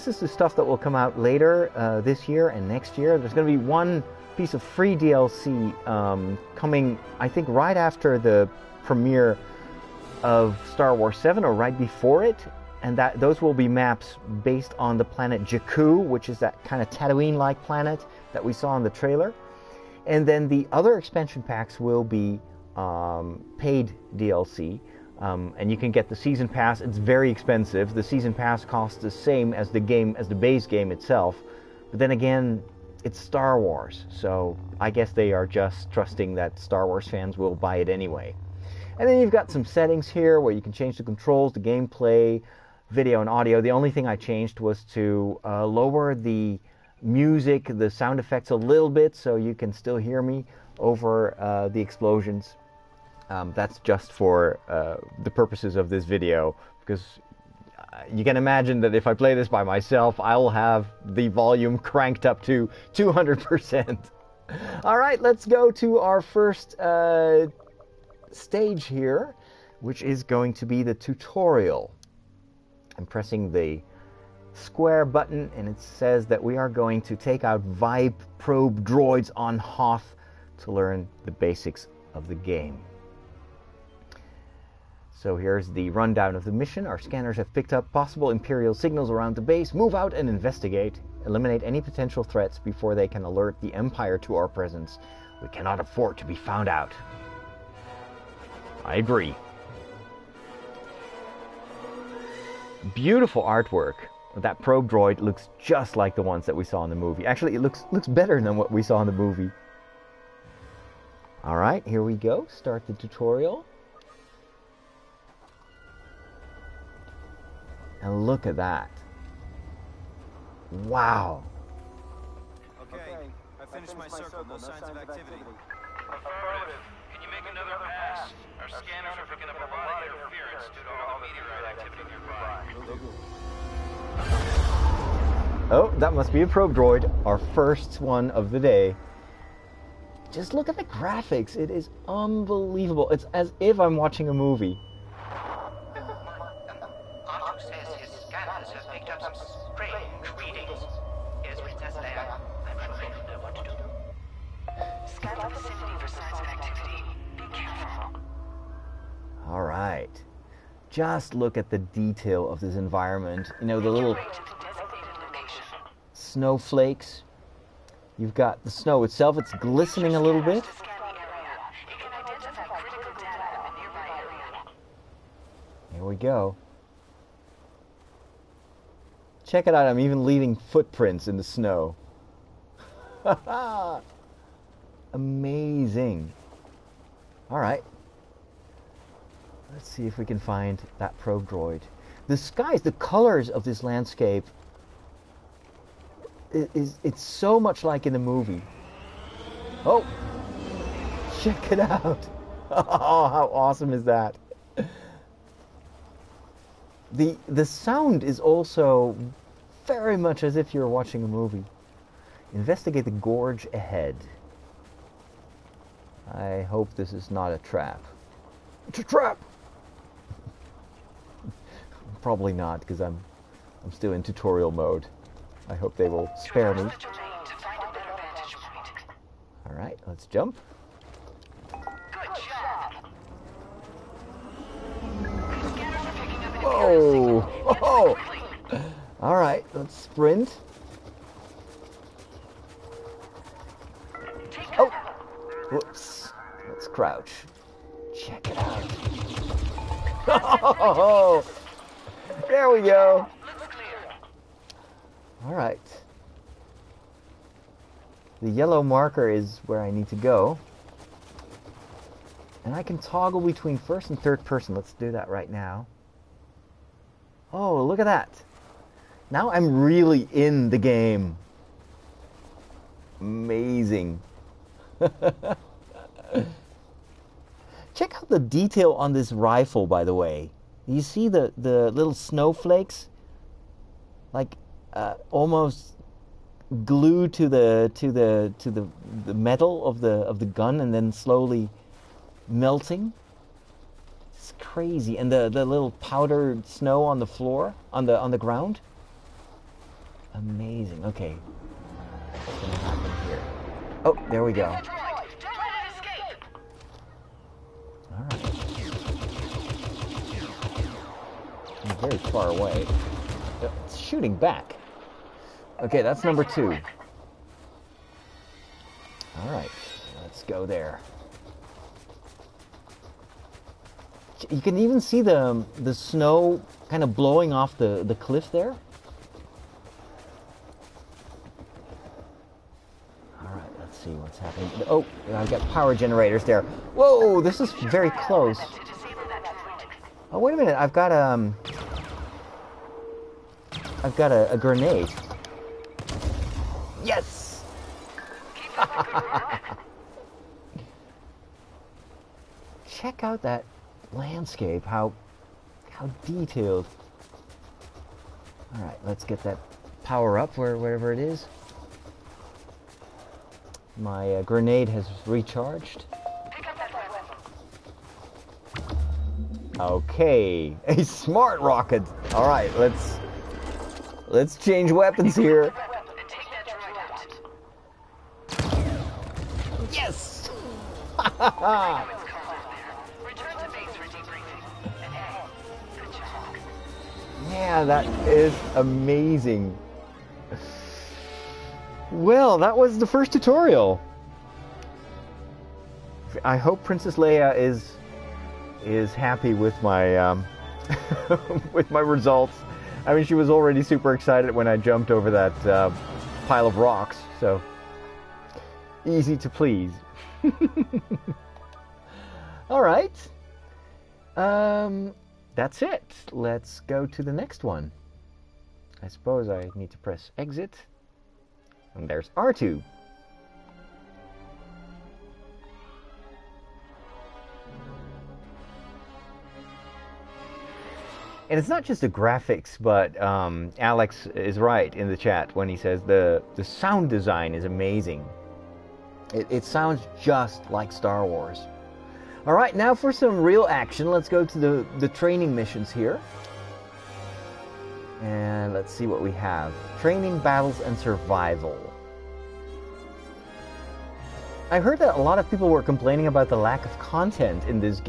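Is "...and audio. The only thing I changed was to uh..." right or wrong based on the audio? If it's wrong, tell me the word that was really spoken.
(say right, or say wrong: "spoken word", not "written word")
right.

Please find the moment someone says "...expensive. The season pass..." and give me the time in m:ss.
0:27.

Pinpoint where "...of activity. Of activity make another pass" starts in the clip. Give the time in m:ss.
2:04.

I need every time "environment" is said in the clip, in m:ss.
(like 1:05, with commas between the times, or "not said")
2:42.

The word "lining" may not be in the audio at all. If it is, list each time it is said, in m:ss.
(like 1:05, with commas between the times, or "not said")
not said.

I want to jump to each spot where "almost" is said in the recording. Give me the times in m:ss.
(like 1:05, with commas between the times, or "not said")
4:45.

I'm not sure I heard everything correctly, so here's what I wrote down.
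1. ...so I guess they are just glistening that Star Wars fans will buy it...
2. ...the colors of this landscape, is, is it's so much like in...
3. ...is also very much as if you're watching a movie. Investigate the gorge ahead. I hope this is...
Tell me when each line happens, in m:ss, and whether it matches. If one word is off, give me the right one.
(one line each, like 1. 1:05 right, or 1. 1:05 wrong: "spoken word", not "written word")
1. 0:34 wrong: "trusting", not "glistening"
2. 3:12 right
3. 3:28 right.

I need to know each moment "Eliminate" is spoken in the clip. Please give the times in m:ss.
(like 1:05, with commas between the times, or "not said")
1:31.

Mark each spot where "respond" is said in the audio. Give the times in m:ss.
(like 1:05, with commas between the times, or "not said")
not said.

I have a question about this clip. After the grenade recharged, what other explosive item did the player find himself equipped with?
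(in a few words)
smart rocket.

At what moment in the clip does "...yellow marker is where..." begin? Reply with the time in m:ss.
4:18.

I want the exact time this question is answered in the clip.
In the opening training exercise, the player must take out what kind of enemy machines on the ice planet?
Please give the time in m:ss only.
1:17.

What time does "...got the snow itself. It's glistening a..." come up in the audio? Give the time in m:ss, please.
2:48.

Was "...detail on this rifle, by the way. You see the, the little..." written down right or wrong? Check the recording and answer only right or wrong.
right.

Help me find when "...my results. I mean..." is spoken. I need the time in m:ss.
6:41.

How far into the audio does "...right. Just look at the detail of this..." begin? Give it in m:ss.
2:39.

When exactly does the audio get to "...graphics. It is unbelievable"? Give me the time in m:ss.
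2:20.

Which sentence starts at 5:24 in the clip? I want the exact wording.
You can even see the the snow kind of blowing off the, the cliff there.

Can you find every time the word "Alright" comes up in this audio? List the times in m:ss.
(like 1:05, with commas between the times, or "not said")
3:07, 3:49, 3:59.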